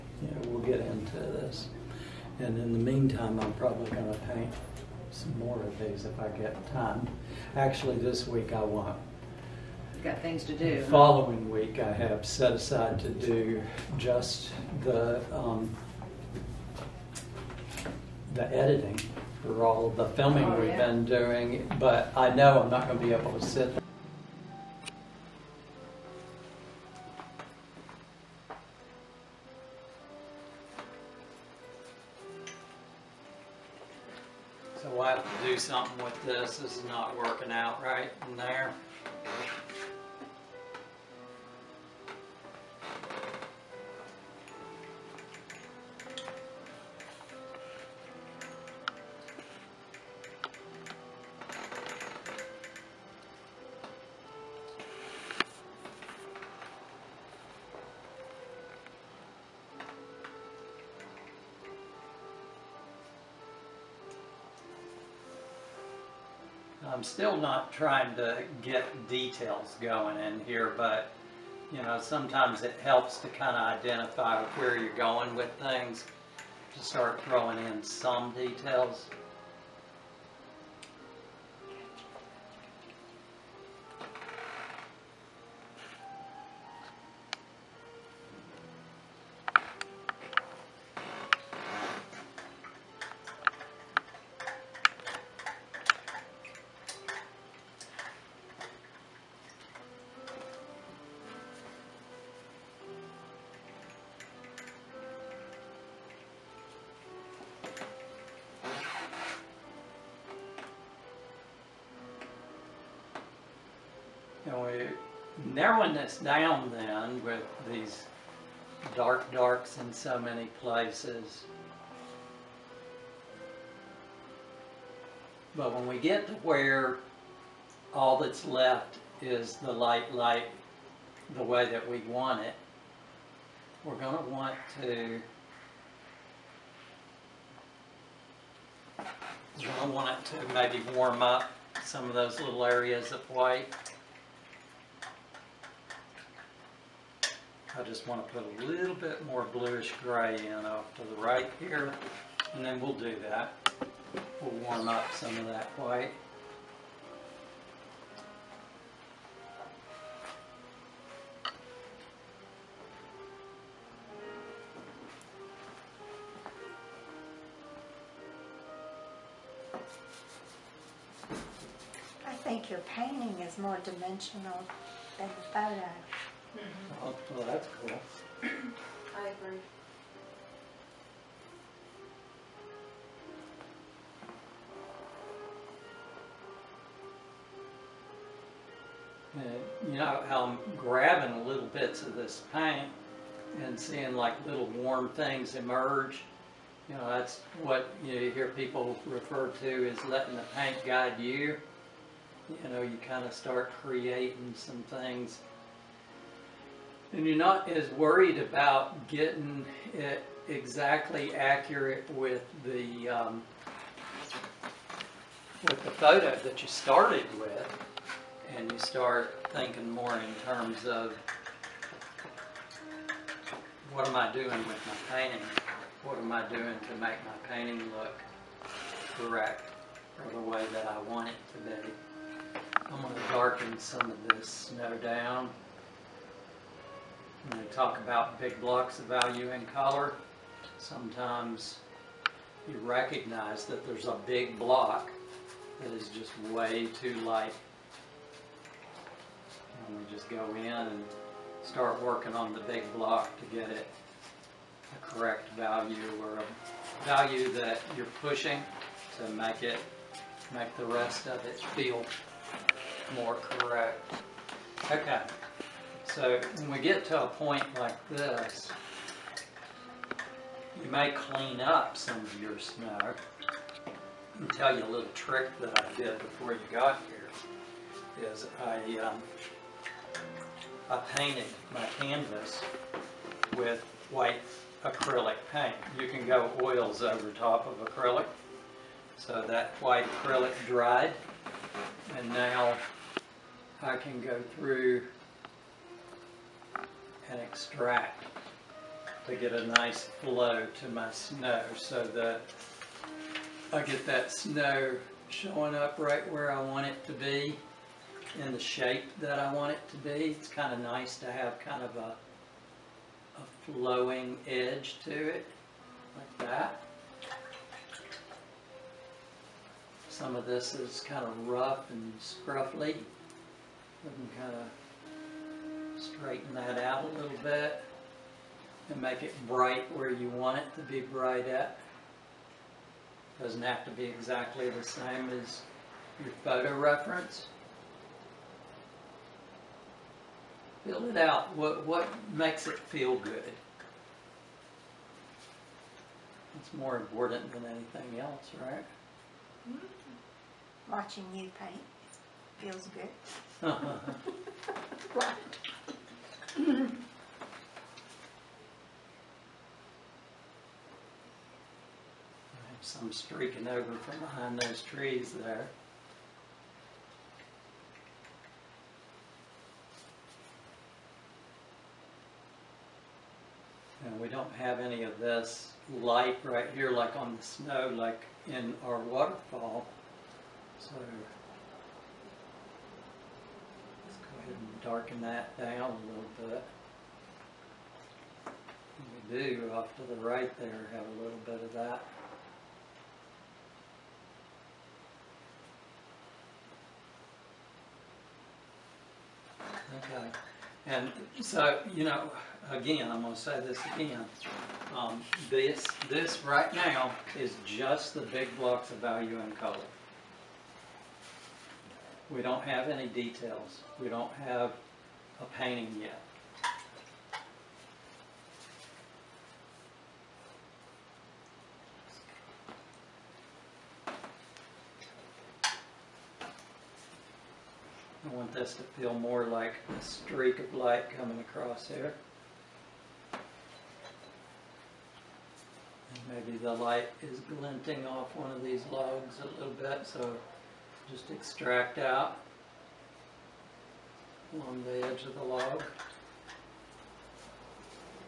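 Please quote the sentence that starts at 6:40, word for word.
Okay, and so, you know, again, I'm going to say this again.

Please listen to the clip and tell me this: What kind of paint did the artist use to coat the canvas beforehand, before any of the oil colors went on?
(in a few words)
white acrylic paint.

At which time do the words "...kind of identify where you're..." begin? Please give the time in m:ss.
1:13.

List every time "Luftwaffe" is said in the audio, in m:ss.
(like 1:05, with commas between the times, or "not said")
not said.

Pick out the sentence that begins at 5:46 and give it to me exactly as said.
It's more important than anything else, right?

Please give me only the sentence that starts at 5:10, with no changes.
It's kind of nice to have kind of a, a flowing edge to it like that.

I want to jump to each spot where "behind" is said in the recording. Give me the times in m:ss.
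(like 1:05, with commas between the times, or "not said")
6:04.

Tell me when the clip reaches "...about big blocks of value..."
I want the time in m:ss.
3:57.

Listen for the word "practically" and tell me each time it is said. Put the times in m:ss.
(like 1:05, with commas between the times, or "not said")
not said.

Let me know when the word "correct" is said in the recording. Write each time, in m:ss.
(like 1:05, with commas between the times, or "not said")
3:49, 4:15, 4:23.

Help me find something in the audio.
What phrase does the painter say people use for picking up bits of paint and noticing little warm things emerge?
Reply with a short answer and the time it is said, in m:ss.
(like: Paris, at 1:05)
letting the paint guide you, at 3:20.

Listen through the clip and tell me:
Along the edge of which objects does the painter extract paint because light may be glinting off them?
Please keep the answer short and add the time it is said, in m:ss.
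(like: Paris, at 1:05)
logs, at 7:18.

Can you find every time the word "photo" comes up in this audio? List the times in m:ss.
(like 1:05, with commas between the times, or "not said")
2:55, 3:35, 5:36.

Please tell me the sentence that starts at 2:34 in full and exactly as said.
We'll warm up some of that white.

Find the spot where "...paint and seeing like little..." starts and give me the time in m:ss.
3:12.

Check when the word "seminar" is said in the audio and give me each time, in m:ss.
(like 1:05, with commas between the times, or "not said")
not said.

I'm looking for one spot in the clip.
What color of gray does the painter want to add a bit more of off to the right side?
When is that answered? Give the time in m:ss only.
2:29.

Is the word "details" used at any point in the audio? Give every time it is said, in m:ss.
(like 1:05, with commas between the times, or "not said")
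1:09, 1:18, 6:53.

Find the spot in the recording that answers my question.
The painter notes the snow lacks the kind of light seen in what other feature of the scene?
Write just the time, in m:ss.
6:18.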